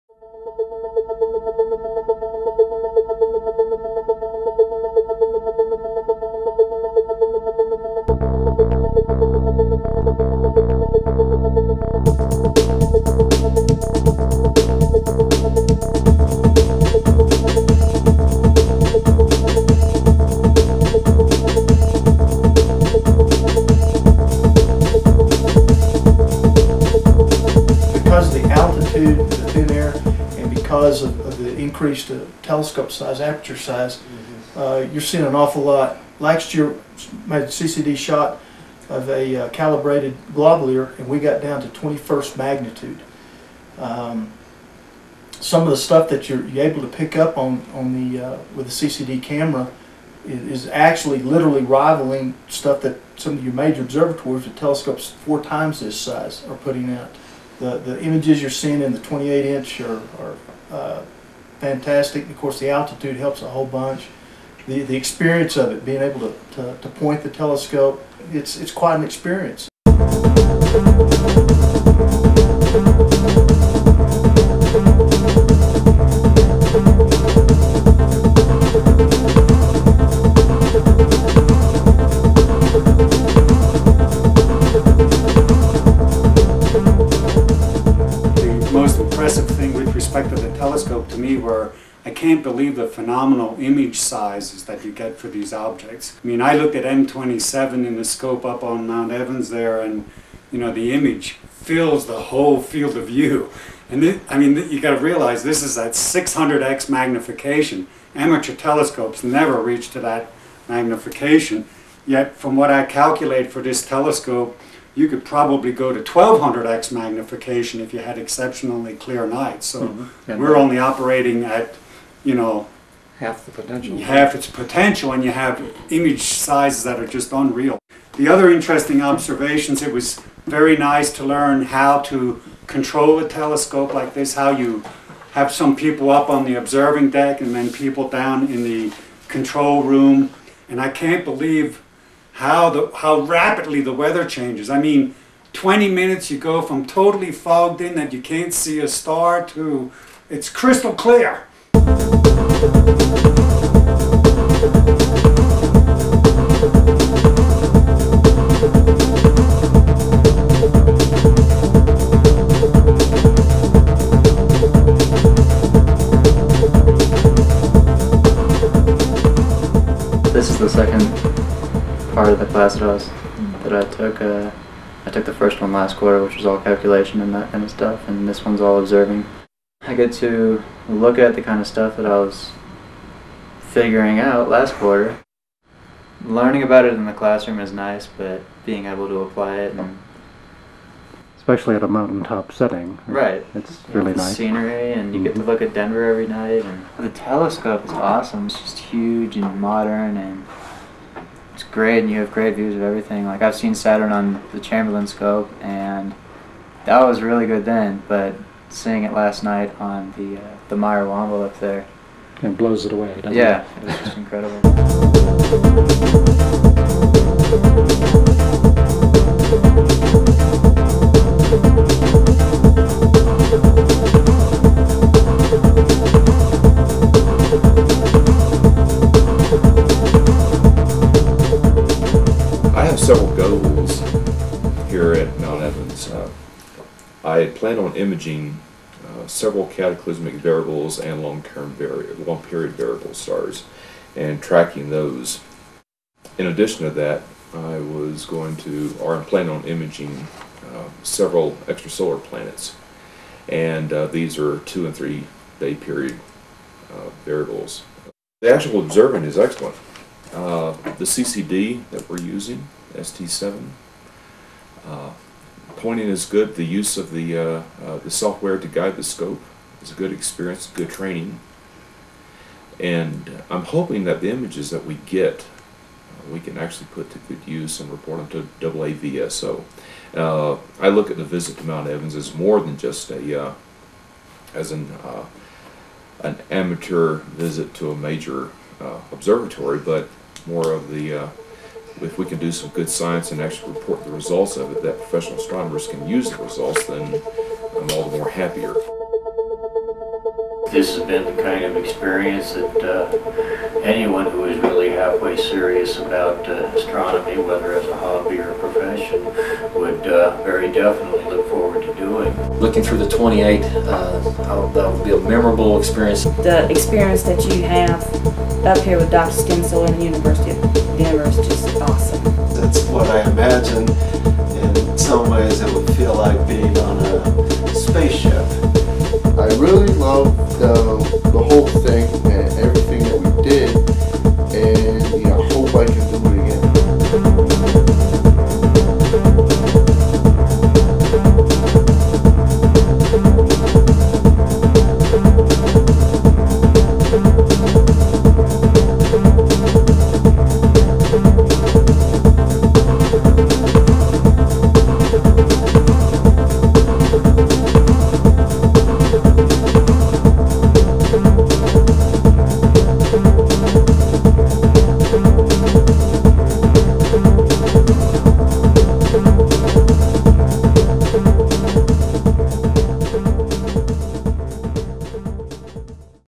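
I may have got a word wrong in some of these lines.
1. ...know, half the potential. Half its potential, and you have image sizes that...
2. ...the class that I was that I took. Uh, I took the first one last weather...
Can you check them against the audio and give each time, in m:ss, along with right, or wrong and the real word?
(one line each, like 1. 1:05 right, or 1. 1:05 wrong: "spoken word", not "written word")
1. 2:02 right
2. 2:52 wrong: "quarter", not "weather".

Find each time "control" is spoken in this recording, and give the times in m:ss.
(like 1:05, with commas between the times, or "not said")
2:12, 2:19.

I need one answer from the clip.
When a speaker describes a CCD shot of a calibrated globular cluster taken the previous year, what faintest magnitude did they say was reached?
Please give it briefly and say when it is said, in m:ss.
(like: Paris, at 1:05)
21st magnitude, at 0:41.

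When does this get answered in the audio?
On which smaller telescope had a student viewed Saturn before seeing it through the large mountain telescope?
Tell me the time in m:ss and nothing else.
3:24.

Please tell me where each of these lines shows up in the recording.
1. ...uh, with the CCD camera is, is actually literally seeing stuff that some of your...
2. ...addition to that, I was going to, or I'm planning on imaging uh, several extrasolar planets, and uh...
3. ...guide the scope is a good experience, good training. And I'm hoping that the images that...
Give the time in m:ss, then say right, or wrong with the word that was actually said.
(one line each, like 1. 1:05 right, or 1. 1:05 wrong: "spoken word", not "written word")
1. 0:48 wrong: "rivaling", not "seeing"
2. 4:06 right
3. 4:28 right.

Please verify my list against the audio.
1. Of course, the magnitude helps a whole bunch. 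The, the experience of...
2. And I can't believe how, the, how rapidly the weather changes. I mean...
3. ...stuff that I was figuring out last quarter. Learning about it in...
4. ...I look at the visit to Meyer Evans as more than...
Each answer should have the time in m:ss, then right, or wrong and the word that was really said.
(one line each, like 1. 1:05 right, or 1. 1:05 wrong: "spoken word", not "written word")
1. 1:02 wrong: "altitude", not "magnitude"
2. 2:20 right
3. 3:01 right
4. 4:40 wrong: "Mount", not "Meyer".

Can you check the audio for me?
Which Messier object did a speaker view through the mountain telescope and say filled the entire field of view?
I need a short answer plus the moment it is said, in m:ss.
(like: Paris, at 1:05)
M27, at 1:36.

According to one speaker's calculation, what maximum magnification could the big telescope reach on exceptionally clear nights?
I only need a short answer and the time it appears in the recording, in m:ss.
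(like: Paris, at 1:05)
1200x, at 1:56.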